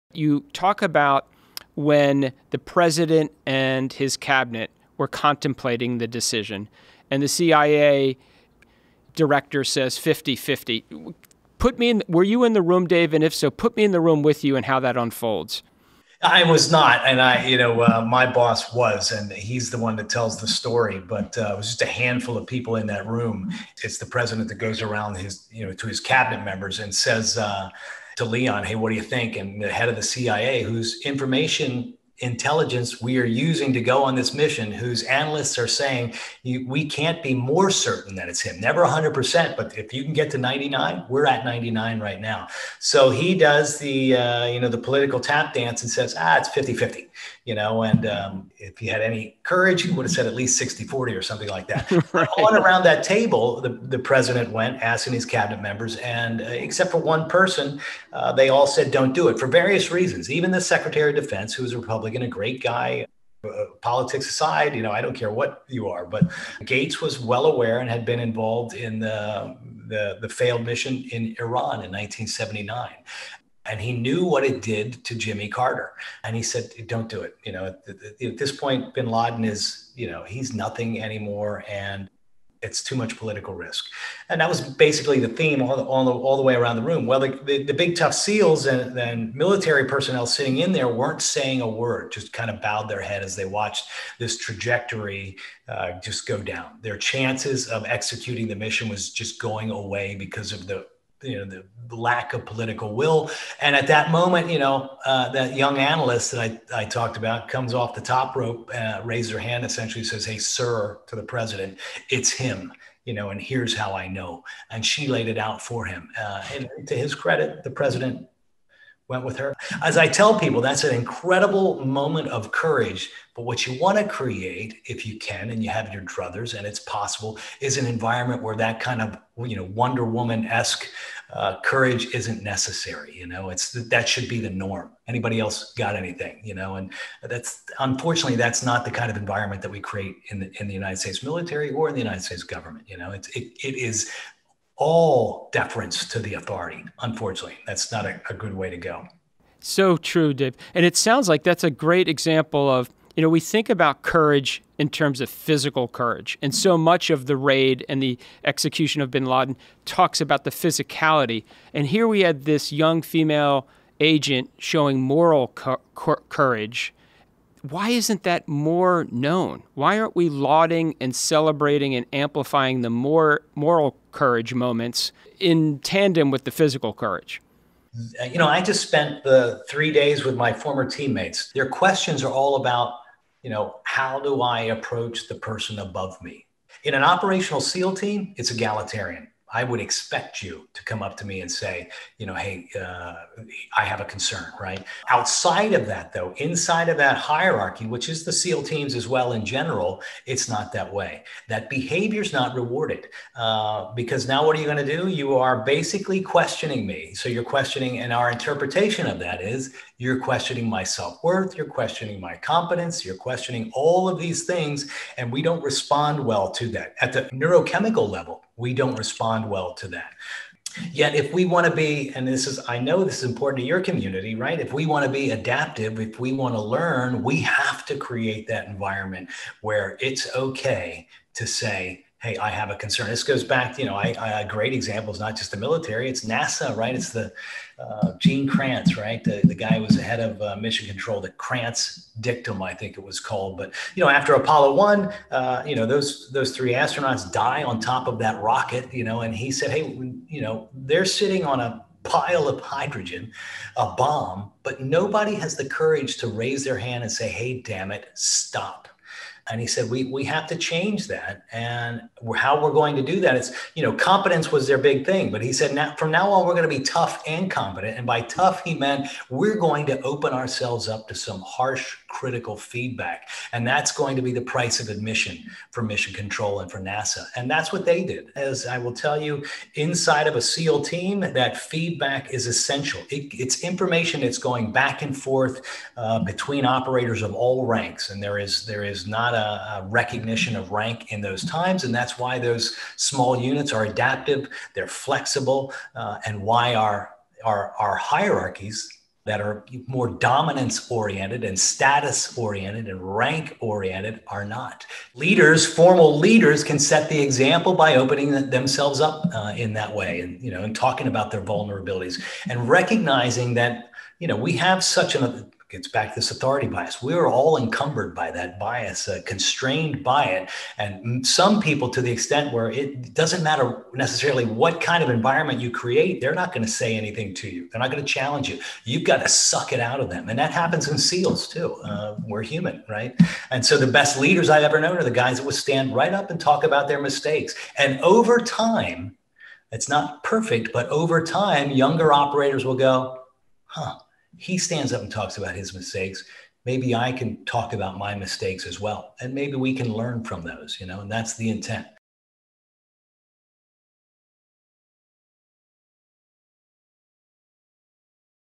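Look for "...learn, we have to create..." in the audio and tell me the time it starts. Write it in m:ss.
3:46.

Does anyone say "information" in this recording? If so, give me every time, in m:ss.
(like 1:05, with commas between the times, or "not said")
0:31, 4:43.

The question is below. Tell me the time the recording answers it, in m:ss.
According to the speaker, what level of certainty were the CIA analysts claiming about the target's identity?
0:41.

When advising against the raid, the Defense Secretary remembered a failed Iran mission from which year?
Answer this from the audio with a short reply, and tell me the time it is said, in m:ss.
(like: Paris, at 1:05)
1979, at 1:11.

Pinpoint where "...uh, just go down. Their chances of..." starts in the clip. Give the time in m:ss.
1:35.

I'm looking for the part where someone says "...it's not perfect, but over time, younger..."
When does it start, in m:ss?
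5:39.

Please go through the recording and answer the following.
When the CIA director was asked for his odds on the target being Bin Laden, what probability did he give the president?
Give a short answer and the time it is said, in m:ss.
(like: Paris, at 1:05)
50-50, at 0:46.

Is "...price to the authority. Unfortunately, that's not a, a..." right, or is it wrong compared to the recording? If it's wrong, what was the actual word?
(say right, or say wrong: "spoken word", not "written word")
wrong: "deference", not "price".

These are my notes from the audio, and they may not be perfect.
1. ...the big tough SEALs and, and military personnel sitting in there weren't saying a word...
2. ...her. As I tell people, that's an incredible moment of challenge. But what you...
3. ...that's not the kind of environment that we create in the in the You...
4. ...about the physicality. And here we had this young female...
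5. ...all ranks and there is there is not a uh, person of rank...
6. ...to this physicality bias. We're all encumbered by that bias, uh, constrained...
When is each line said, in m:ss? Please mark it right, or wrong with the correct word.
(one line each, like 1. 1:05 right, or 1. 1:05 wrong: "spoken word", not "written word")
1. 1:27 right
2. 1:59 wrong: "courage", not "challenge"
3. 2:18 wrong: "United", not "You"
4. 2:40 right
5. 4:47 wrong: "recognition", not "person"
6. 5:16 wrong: "authority", not "physicality".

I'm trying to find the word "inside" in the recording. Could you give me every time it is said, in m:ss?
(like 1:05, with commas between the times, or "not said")
3:16, 4:39.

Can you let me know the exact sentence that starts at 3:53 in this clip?
This goes back, you know, I, I great example is not just the military, it's NASA, right?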